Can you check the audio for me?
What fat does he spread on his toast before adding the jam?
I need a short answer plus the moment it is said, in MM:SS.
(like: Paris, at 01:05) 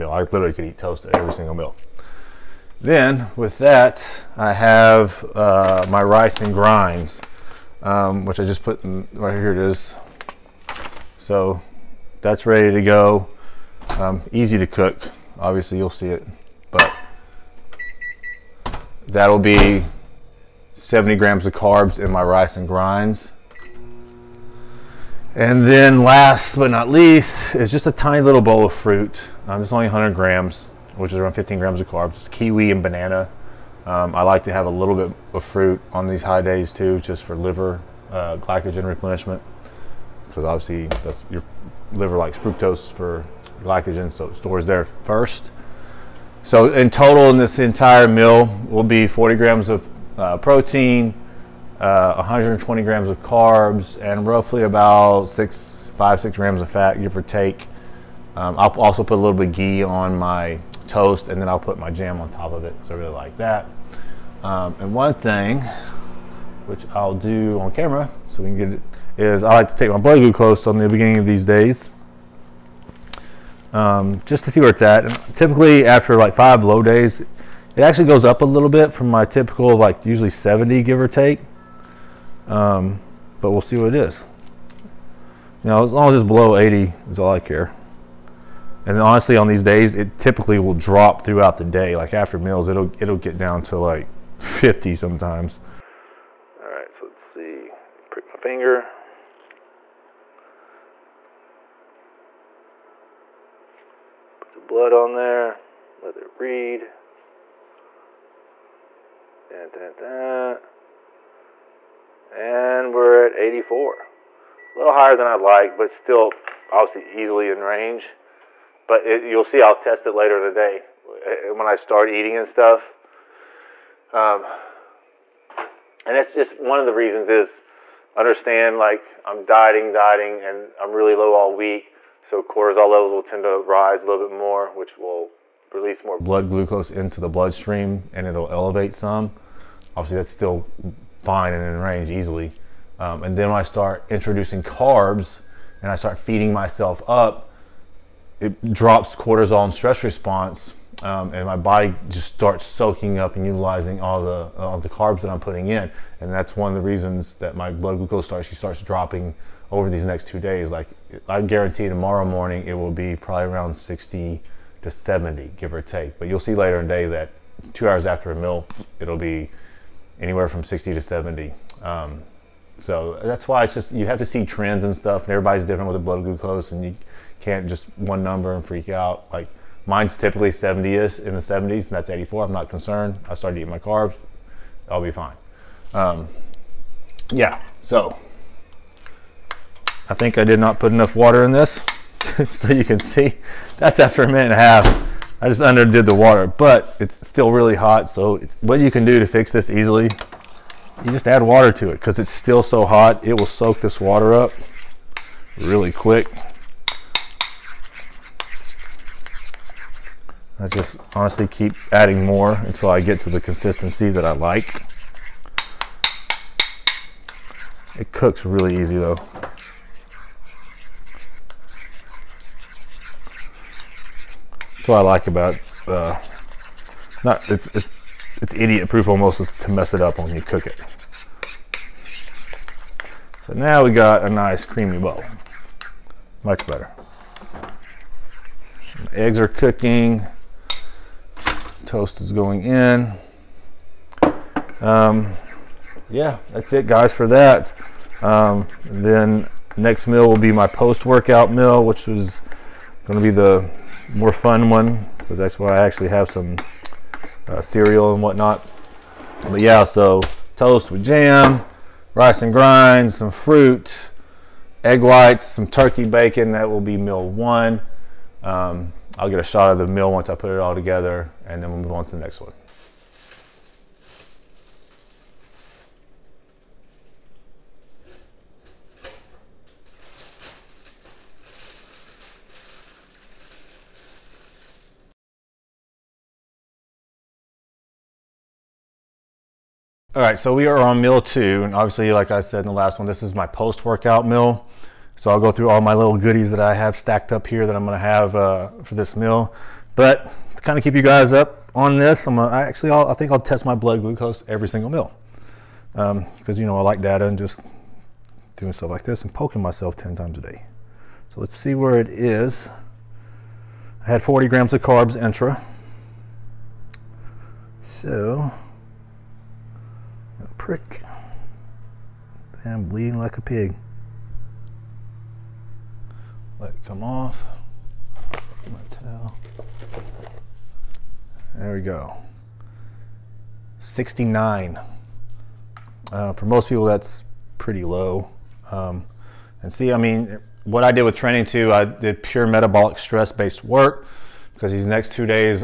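Ghee, at 00:59.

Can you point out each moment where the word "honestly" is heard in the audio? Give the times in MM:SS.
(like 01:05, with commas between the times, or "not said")
01:28, 03:31.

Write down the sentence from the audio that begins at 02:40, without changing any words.
Like I guarantee tomorrow morning it will be probably around 60 to 70, give or take.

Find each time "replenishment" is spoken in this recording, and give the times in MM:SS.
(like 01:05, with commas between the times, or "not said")
00:38.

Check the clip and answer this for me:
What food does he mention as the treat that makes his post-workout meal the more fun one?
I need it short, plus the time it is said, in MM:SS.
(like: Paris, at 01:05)
Cereal, at 04:17.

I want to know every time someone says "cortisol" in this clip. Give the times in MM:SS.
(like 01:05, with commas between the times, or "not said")
02:12, 02:29.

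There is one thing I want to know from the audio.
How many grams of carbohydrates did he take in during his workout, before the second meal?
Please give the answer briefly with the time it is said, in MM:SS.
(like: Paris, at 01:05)
40 grams, at 05:14.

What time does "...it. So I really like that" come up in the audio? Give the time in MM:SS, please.
01:02.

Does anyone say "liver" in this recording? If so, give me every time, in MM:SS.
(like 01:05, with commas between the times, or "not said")
00:37, 00:41.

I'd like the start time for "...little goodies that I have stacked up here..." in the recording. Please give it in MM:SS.
04:55.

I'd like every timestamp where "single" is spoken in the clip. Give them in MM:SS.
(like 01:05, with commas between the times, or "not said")
00:01, 05:04.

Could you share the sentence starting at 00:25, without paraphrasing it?
And then last but not least is just a tiny little bowl of fruit.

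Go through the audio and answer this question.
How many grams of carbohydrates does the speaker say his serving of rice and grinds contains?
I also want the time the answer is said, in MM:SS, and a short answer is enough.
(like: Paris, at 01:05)
70 grams, at 00:20.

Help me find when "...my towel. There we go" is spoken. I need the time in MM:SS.
05:28.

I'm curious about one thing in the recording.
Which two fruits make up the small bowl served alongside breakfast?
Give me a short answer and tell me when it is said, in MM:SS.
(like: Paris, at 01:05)
Kiwi and banana, at 00:32.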